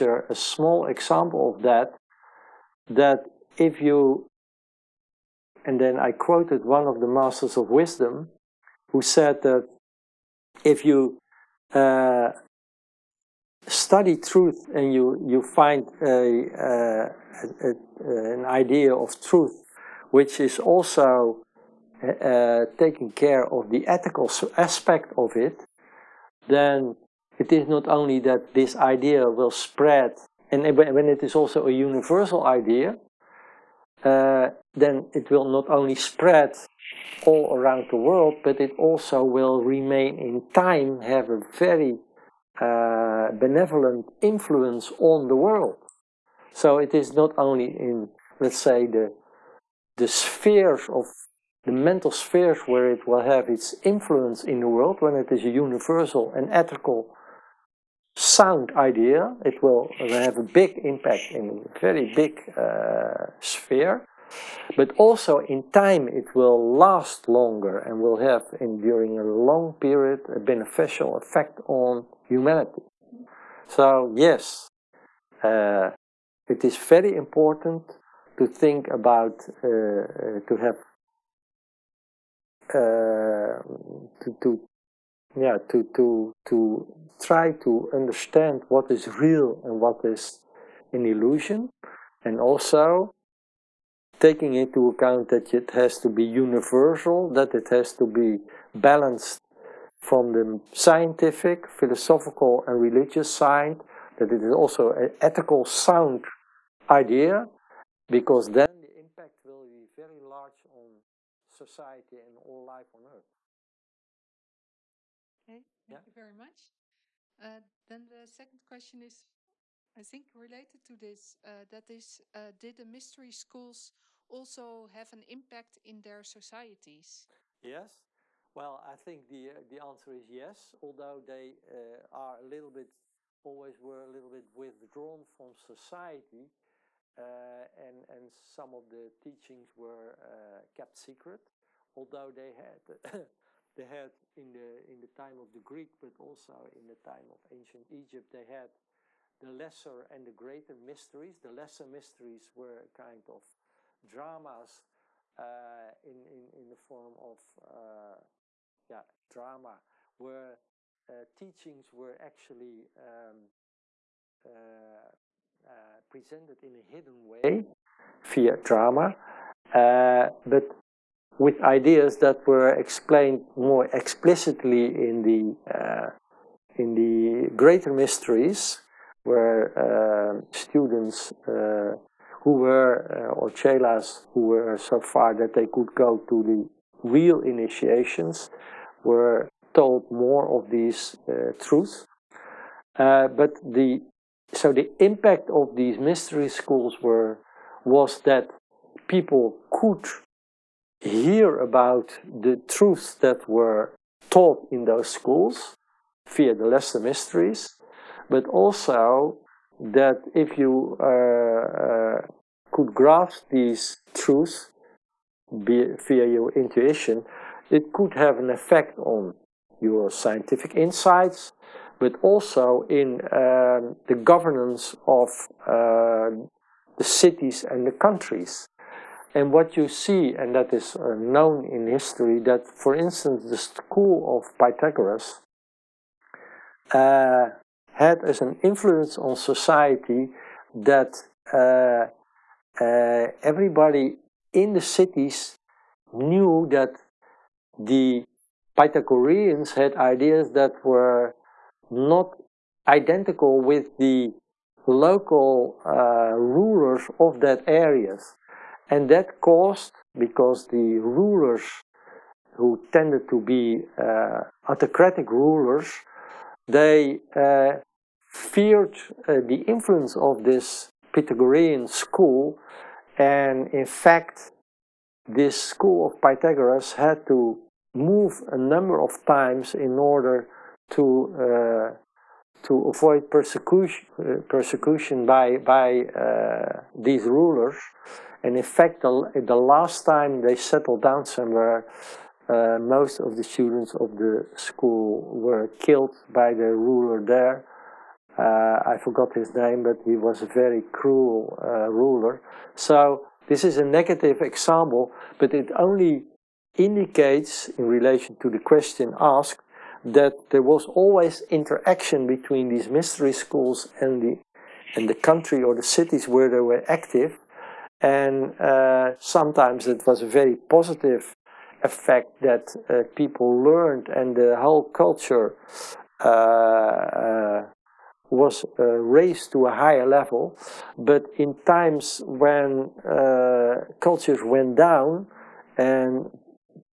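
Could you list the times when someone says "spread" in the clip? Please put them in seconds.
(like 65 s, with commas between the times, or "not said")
29 s, 35 s.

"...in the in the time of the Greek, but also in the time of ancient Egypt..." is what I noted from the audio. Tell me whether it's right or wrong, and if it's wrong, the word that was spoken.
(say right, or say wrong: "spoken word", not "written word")
right.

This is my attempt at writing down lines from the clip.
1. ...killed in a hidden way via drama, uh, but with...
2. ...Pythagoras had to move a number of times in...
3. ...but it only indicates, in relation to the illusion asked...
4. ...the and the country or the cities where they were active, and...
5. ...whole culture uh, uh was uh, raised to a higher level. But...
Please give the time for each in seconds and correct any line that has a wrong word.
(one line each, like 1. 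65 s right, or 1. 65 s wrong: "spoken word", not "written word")
1. 166 s wrong: "presented", not "killed"
2. 276 s right
3. 305 s wrong: "question", not "illusion"
4. 314 s right
5. 324 s right.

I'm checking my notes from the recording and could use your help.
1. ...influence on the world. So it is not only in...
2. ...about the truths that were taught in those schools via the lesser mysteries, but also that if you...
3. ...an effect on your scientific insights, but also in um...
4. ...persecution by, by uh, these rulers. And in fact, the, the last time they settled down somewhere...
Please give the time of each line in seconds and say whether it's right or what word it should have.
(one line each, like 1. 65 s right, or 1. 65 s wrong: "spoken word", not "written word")
1. 44 s right
2. 201 s right
3. 218 s right
4. 284 s right.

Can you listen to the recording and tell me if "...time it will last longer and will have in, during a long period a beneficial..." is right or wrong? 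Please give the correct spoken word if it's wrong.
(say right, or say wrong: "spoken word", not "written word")
right.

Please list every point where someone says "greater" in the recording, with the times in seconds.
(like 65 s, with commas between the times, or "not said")
150 s, 177 s.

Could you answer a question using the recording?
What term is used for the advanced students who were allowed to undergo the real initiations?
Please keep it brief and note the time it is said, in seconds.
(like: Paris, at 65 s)
Chelas, at 183 s.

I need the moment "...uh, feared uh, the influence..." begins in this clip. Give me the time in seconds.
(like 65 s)
267 s.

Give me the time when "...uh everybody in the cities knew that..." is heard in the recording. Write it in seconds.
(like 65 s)
242 s.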